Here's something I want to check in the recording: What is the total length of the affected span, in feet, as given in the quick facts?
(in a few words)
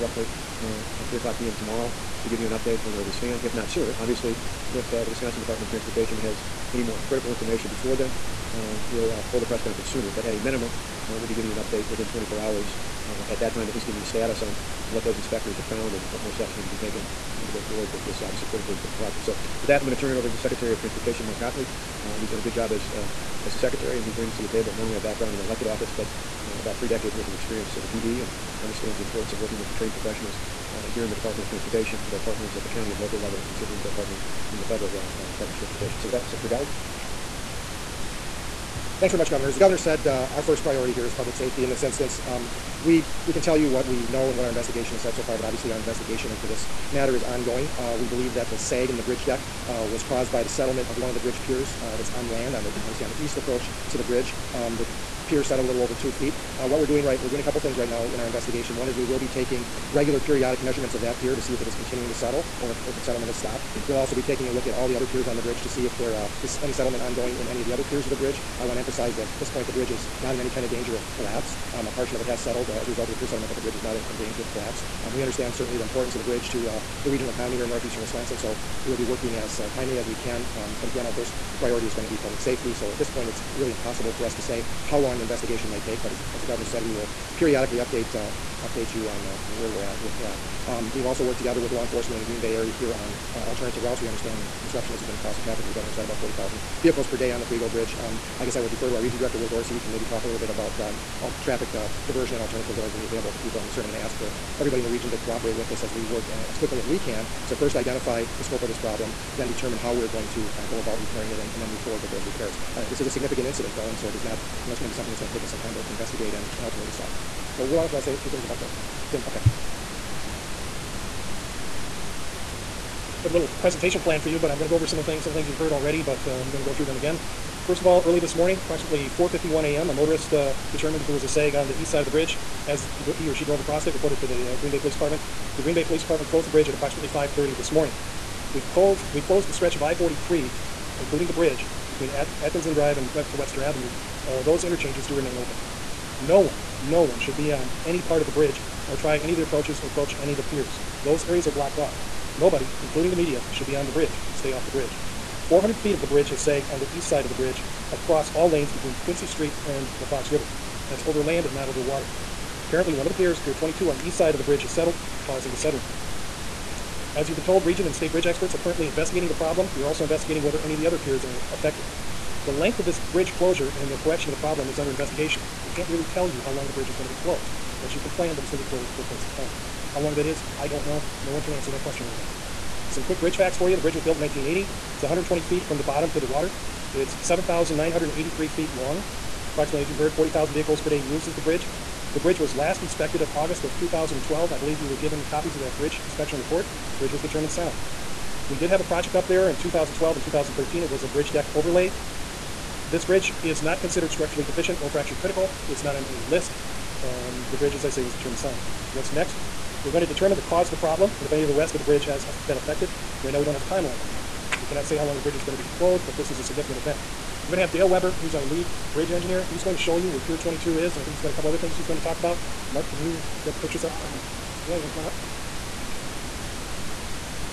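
7,983 feet.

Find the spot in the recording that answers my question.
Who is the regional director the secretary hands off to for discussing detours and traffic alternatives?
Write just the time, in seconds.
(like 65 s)
99 s.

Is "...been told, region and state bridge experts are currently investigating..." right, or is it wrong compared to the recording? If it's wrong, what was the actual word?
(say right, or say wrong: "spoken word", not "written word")
right.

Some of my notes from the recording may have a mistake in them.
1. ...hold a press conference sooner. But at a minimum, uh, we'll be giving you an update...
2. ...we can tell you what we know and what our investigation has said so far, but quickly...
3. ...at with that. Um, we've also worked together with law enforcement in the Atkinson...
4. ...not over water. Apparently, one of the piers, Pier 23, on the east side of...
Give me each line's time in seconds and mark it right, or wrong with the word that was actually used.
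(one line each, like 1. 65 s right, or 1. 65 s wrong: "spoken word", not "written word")
1. 9 s right
2. 43 s wrong: "obviously", not "quickly"
3. 89 s wrong: "Green", not "Atkinson"
4. 161 s wrong: "22", not "23".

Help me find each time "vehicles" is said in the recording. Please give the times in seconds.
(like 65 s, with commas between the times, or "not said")
96 s, 190 s.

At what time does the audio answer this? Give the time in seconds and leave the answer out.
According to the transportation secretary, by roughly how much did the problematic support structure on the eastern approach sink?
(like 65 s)
55 s.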